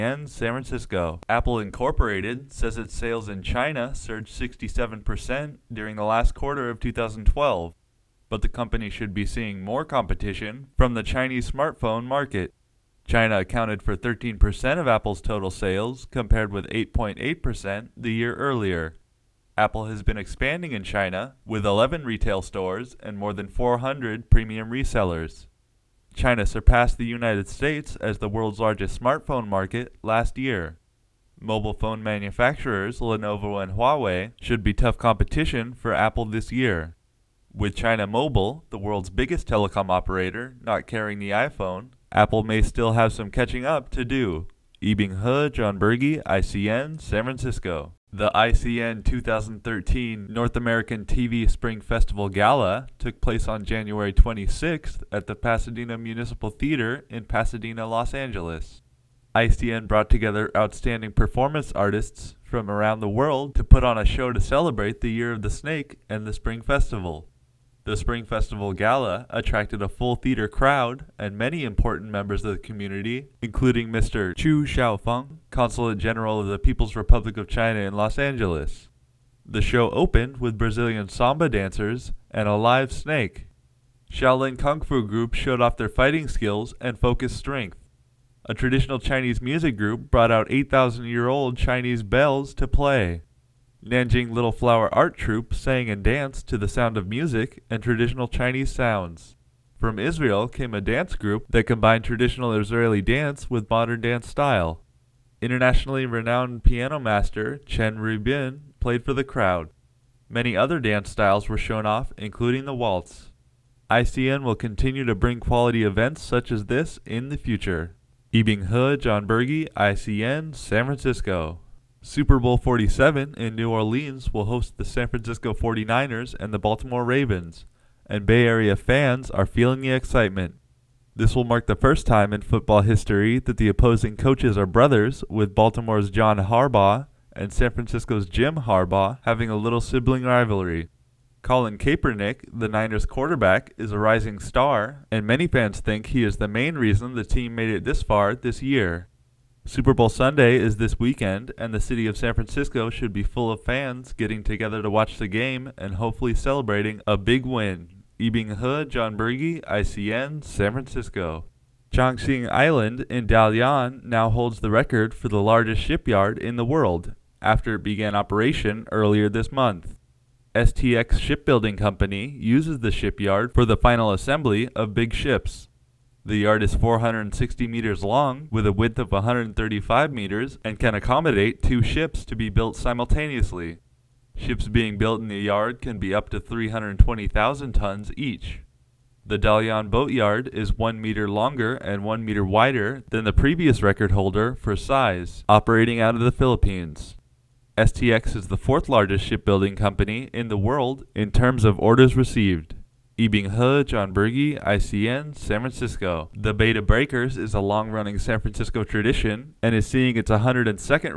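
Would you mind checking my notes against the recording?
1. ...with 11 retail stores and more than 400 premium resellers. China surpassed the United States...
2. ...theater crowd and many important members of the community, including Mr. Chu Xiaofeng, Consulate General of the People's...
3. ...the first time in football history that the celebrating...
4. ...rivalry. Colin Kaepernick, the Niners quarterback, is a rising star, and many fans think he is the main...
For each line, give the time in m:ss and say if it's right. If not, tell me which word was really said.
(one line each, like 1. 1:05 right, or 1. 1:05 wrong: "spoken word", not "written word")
1. 0:21 right
2. 1:10 right
3. 2:11 wrong: "opposing", not "celebrating"
4. 2:20 right.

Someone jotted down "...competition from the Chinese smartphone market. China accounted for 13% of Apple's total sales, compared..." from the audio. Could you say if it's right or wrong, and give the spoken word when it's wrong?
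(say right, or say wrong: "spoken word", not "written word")
right.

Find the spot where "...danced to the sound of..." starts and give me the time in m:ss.
1:36.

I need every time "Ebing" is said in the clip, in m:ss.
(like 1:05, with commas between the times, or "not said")
0:44, 1:58, 2:38, 3:23.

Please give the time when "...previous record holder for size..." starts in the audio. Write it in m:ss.
3:13.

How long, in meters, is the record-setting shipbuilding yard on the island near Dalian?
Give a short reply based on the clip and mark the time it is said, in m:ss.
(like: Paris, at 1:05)
460 meters, at 2:56.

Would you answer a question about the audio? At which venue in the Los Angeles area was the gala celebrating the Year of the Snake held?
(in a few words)
Pasadena Municipal Theater.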